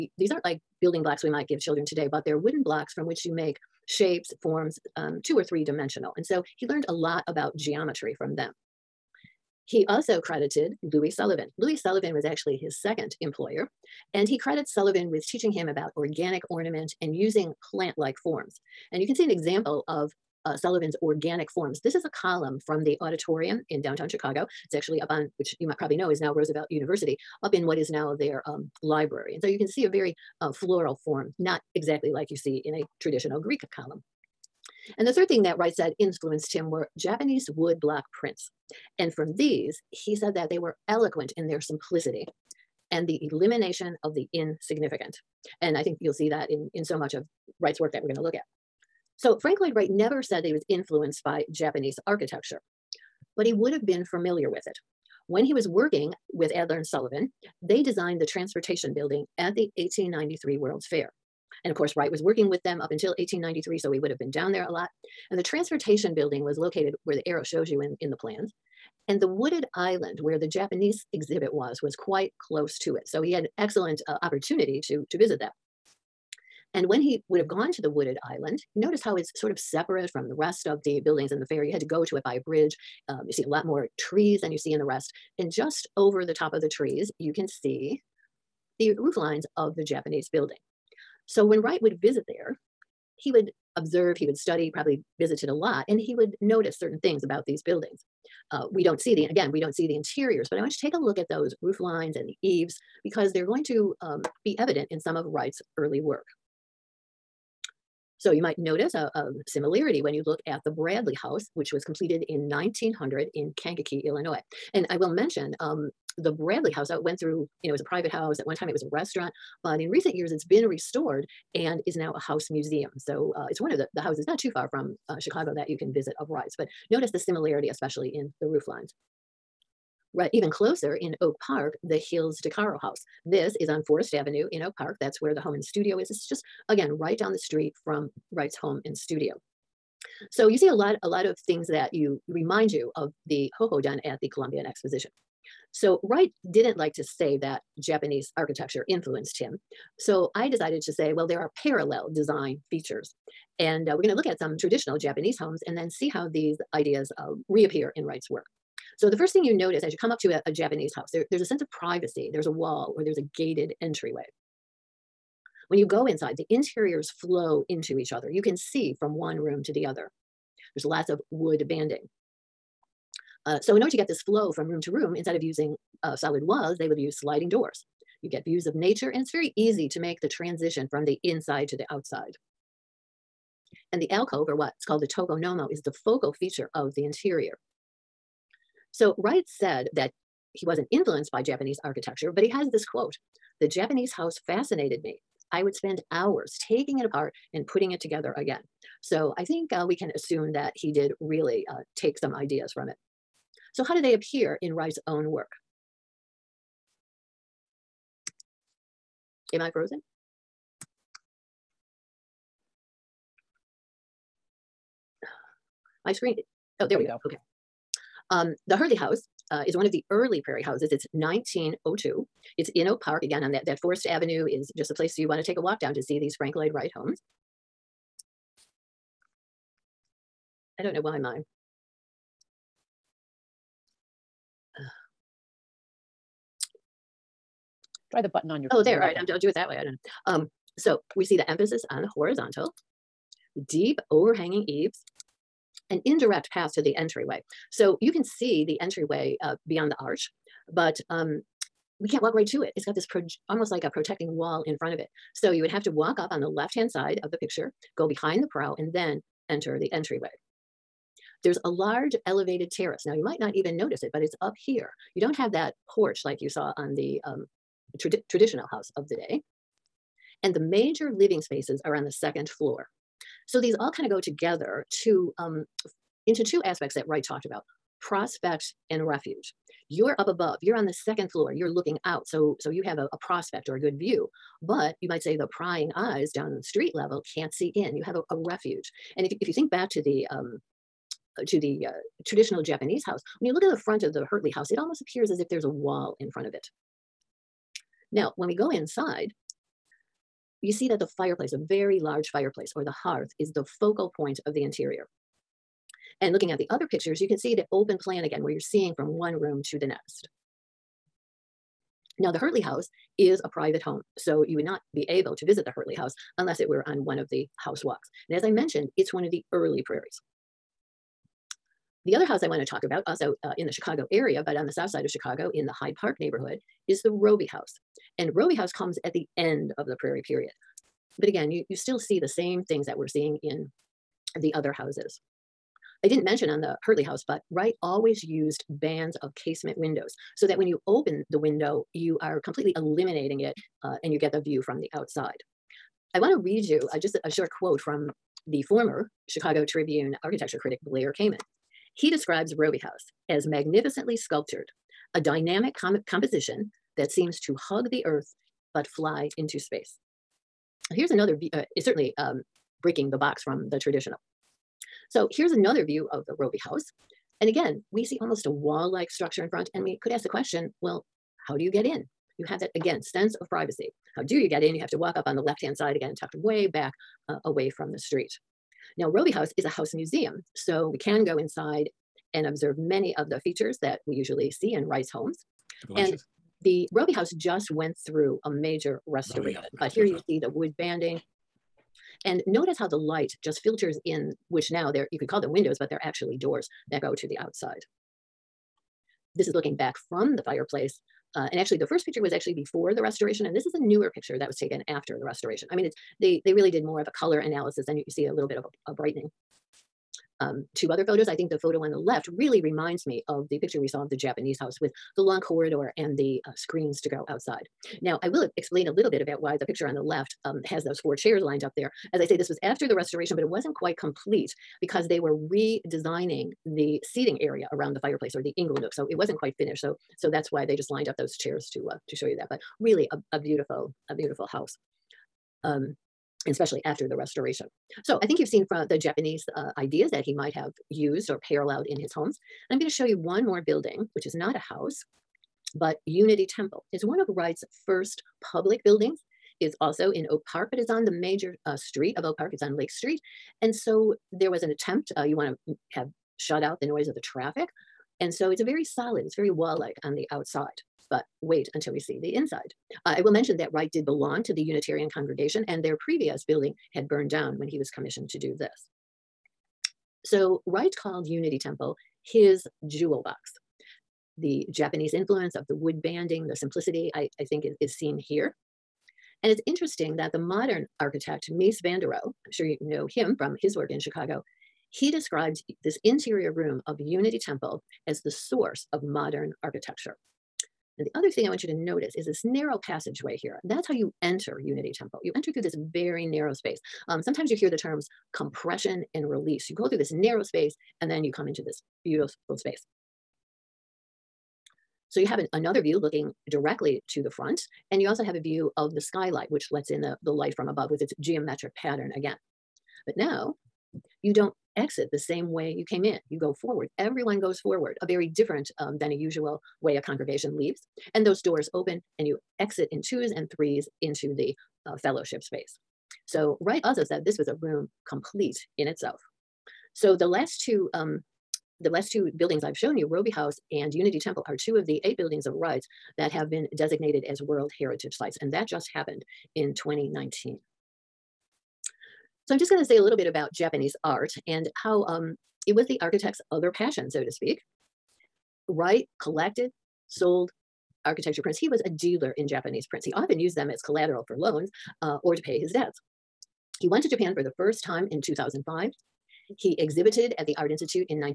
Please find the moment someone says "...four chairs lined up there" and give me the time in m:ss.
7:01.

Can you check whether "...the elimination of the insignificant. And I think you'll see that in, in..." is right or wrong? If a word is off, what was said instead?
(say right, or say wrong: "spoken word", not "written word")
right.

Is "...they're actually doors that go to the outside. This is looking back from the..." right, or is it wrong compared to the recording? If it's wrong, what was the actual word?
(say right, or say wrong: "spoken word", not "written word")
right.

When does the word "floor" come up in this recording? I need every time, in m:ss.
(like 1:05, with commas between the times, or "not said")
4:32, 4:41.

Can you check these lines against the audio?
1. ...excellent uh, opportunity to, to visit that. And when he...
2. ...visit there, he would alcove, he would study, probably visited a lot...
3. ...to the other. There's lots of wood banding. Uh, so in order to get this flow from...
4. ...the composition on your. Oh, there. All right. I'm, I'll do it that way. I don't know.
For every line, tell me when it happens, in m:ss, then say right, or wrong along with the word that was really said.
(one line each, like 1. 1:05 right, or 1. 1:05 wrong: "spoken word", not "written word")
1. 1:13 right
2. 1:32 wrong: "observe", not "alcove"
3. 2:49 right
4. 3:58 wrong: "button", not "composition".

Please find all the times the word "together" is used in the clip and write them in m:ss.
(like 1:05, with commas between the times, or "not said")
3:17, 4:34.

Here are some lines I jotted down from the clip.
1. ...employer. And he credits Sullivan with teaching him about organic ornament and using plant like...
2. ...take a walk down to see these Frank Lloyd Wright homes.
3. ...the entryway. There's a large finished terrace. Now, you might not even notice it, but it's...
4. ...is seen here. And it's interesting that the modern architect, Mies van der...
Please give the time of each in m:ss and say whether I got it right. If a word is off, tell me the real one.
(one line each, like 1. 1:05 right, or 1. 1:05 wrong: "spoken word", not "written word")
1. 0:13 right
2. 3:45 right
3. 4:19 wrong: "elevated", not "finished"
4. 7:57 right.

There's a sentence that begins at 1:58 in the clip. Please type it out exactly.
At one time it was a restaurant, but in recent years it's been restored and is now a house museum.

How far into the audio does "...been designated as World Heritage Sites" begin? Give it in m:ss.
8:56.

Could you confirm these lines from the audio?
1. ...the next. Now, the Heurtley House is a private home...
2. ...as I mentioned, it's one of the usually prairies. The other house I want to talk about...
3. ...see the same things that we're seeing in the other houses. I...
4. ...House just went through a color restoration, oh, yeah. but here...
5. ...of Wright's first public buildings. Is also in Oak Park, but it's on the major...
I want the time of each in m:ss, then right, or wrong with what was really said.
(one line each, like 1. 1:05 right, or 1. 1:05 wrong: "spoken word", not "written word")
1. 5:09 right
2. 5:18 wrong: "early", not "usually"
3. 5:31 right
4. 6:27 wrong: "major", not "color"
5. 7:27 right.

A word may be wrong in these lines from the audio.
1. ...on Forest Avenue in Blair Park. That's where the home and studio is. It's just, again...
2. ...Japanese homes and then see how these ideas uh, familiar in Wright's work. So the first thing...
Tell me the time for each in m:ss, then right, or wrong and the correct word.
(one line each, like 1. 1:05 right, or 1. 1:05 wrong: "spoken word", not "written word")
1. 2:13 wrong: "Oak", not "Blair"
2. 2:34 wrong: "reappear", not "familiar".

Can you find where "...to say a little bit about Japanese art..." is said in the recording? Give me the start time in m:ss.
9:02.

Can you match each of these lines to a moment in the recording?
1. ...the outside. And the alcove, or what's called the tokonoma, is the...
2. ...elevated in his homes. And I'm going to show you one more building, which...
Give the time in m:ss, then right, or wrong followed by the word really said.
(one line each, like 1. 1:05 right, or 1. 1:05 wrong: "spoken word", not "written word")
1. 3:01 right
2. 7:21 wrong: "paralleled", not "elevated".